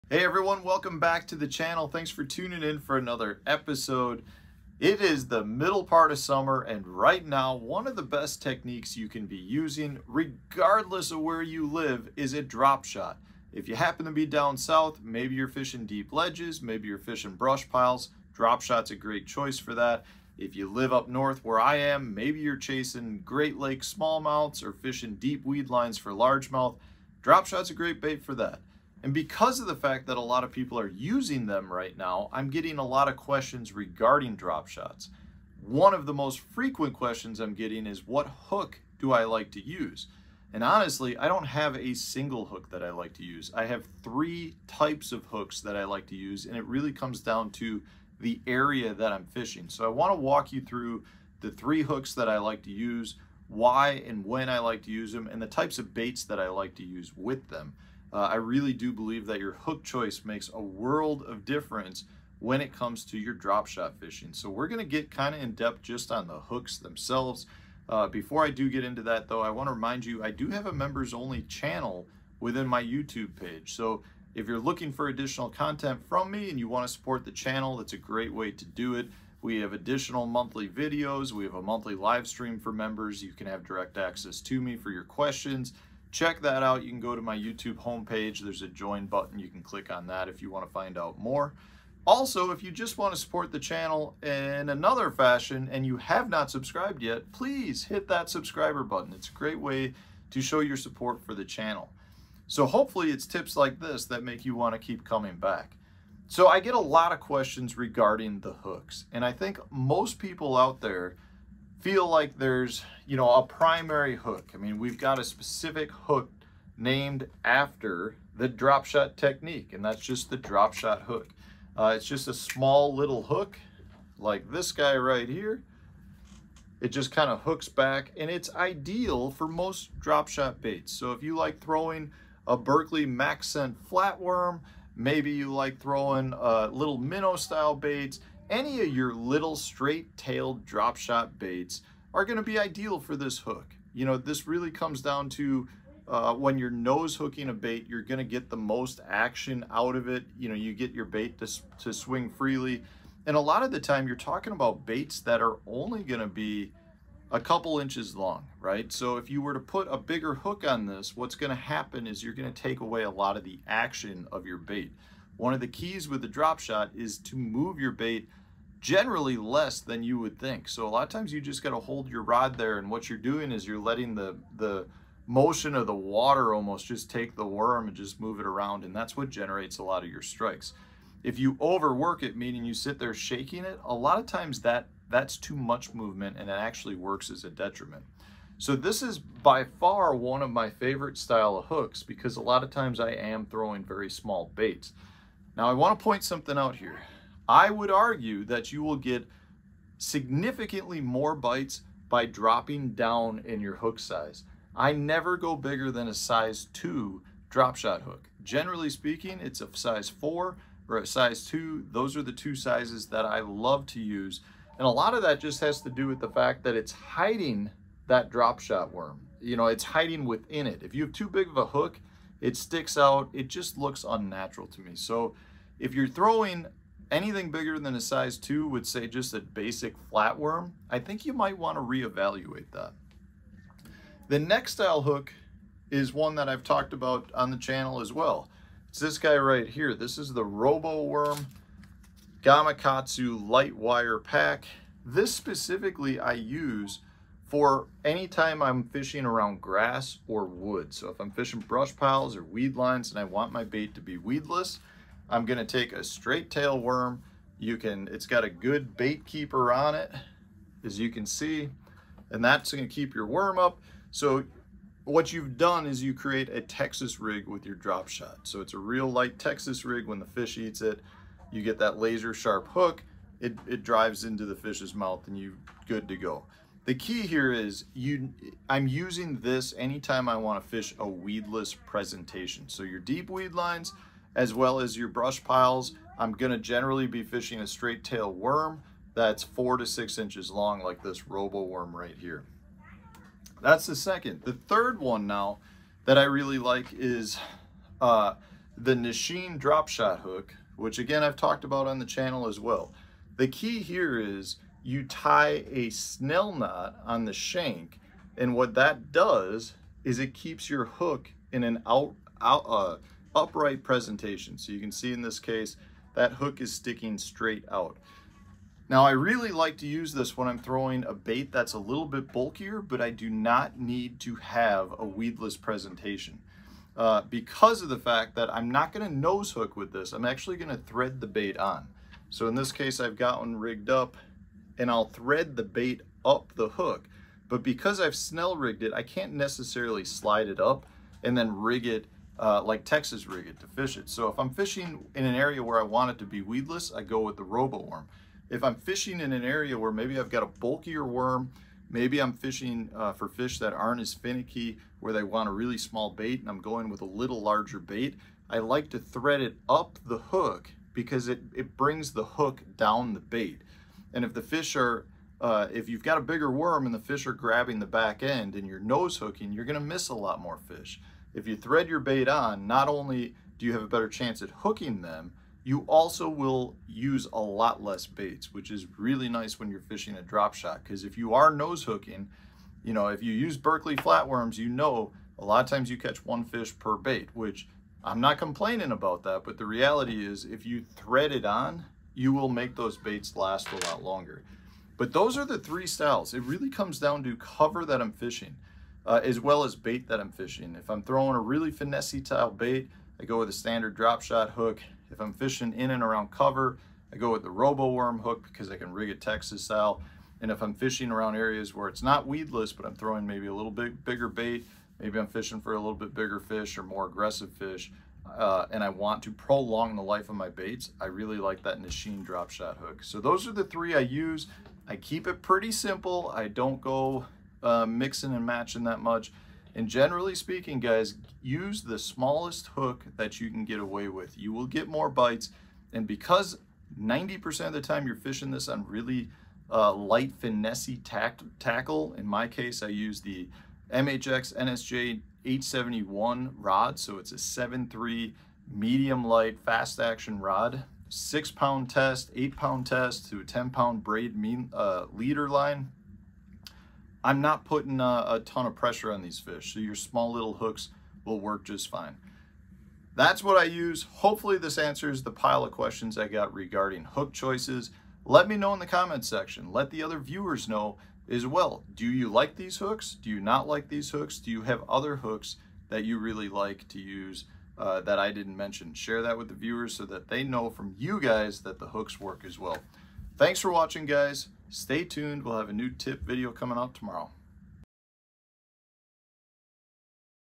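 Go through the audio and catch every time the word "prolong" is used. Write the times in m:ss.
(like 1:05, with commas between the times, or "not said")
6:59.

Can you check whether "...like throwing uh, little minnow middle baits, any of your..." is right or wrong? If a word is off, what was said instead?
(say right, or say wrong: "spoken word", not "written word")
wrong: "style", not "middle".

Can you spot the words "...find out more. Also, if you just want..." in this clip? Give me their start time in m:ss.
1:30.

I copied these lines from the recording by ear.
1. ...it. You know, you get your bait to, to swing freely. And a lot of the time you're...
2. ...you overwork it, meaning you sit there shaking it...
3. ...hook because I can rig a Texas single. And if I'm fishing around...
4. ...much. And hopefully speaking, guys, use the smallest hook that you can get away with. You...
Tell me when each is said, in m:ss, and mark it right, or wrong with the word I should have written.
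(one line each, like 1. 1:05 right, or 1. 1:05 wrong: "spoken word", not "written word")
1. 2:30 right
2. 3:01 right
3. 6:48 wrong: "style", not "single"
4. 7:08 wrong: "generally", not "hopefully".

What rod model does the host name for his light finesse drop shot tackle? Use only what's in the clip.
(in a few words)
MHX NSJ 871.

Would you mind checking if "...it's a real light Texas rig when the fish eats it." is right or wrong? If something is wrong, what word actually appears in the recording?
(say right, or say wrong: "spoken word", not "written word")
right.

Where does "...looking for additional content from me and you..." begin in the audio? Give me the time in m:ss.
1:14.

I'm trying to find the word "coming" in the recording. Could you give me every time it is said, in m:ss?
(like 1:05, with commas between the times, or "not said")
1:45, 8:06.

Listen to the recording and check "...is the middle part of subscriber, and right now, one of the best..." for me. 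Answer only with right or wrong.
wrong.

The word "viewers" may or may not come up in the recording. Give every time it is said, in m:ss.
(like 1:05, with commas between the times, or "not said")
7:50, 7:59.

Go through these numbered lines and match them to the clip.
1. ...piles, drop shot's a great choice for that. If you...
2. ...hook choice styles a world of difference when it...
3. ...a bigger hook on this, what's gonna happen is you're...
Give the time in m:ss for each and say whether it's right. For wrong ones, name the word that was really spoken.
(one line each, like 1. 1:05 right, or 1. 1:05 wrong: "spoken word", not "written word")
1. 0:17 right
2. 0:59 wrong: "makes", not "styles"
3. 2:39 right.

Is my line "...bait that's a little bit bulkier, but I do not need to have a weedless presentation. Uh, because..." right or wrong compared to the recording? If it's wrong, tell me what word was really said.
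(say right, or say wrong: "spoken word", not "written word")
right.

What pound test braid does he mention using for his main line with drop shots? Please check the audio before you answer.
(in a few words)
10 pound.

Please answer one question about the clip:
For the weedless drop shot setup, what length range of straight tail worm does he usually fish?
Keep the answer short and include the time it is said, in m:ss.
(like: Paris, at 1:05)
4 to 6 inches, at 4:49.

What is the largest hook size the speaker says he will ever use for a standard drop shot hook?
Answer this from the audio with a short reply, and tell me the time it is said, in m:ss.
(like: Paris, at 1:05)
Size 2, at 3:26.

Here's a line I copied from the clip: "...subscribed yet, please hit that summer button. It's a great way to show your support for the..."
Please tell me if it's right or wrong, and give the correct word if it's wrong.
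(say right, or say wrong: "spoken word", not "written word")
wrong: "subscriber", not "summer".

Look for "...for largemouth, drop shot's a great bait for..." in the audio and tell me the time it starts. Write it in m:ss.
0:25.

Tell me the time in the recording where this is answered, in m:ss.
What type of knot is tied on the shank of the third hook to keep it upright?
5:05.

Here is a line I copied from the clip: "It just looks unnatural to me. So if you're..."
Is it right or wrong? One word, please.
right.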